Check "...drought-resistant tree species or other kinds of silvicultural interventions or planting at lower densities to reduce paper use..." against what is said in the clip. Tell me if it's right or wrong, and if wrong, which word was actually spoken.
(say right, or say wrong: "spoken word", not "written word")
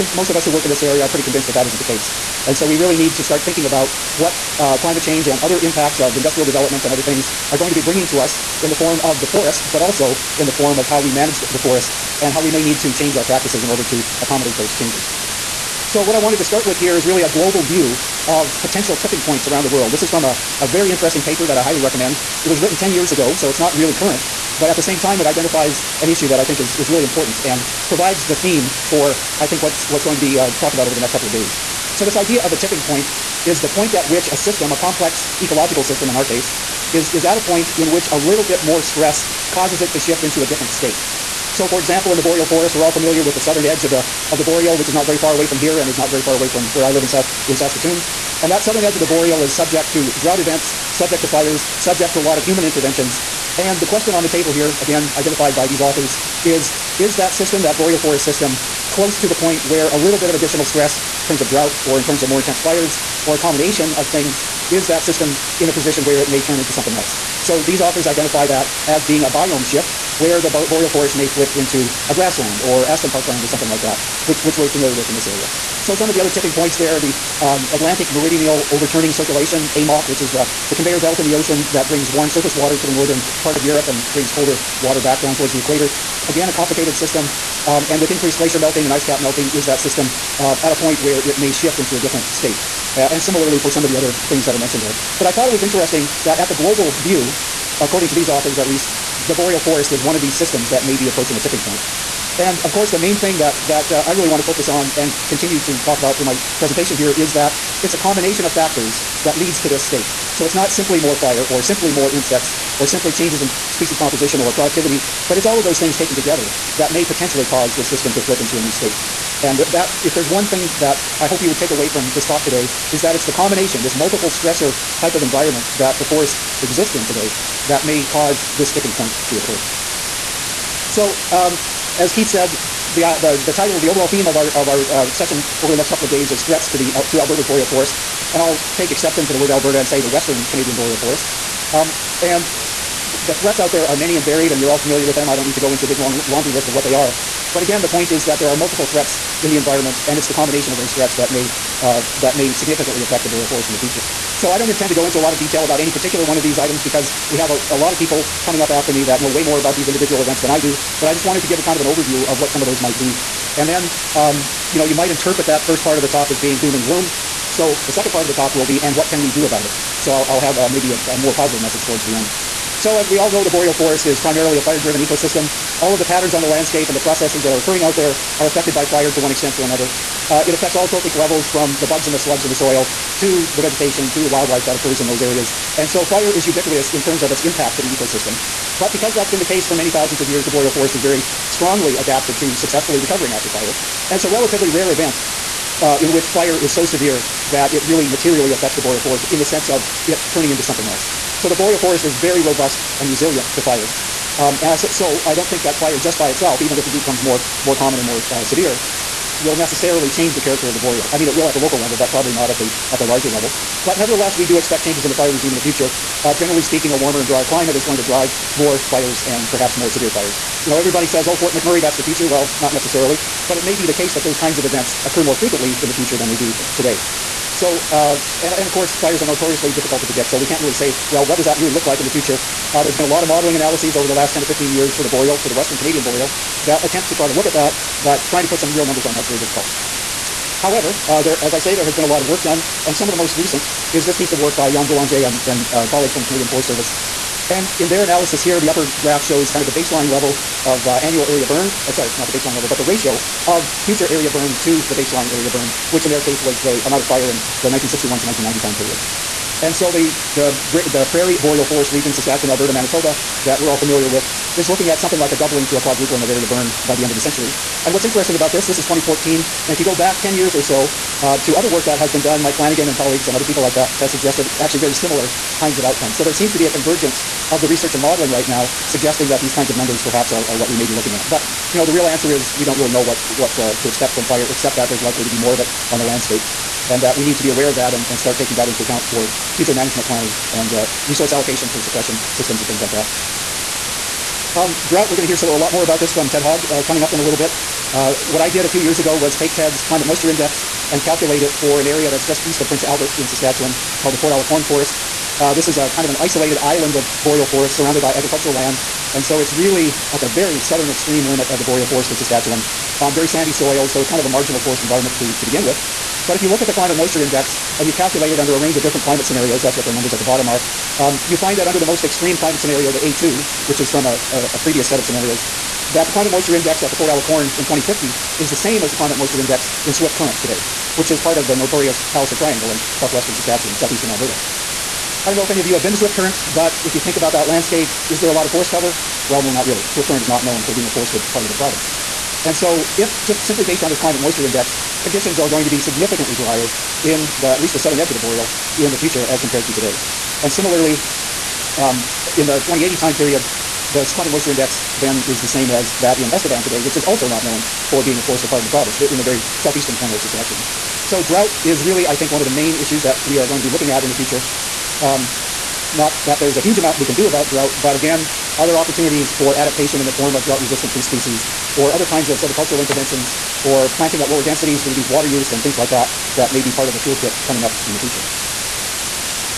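wrong: "water", not "paper".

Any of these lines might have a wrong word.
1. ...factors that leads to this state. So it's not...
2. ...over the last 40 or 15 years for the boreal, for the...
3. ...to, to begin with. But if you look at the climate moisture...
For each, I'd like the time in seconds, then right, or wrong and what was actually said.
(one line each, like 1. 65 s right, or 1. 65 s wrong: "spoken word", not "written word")
1. 108 s right
2. 233 s wrong: "10", not "40"
3. 315 s right.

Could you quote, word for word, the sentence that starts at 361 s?
So drought is really, I think, one of the main issues that we are going to be looking at in the future.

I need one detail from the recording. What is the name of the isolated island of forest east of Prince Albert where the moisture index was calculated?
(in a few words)
Fort à la Corne Forest.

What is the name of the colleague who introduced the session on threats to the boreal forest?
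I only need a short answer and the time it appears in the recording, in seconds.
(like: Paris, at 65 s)
Keith, at 132 s.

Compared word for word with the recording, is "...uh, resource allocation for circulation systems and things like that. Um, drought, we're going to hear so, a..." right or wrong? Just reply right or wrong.
wrong.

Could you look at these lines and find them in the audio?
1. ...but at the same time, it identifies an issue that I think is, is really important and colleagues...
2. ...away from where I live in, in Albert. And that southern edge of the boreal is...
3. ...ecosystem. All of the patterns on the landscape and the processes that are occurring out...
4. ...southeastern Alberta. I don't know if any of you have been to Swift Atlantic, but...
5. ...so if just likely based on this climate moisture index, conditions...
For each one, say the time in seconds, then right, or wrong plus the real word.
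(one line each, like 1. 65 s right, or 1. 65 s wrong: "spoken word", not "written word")
1. 24 s wrong: "provides", not "colleagues"
2. 46 s wrong: "Saskatoon", not "Albert"
3. 174 s right
4. 333 s wrong: "Current", not "Atlantic"
5. 342 s wrong: "simply", not "likely".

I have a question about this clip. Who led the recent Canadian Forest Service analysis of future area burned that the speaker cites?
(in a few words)
Yan Boulanger.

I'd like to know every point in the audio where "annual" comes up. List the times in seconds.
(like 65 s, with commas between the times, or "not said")
250 s.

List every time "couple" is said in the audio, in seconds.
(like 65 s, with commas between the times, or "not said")
31 s, 135 s.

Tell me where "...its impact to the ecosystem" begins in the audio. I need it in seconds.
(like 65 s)
187 s.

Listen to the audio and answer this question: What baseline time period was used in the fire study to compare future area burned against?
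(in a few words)
1961 to 1990.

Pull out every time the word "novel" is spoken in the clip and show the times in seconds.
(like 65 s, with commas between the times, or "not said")
not said.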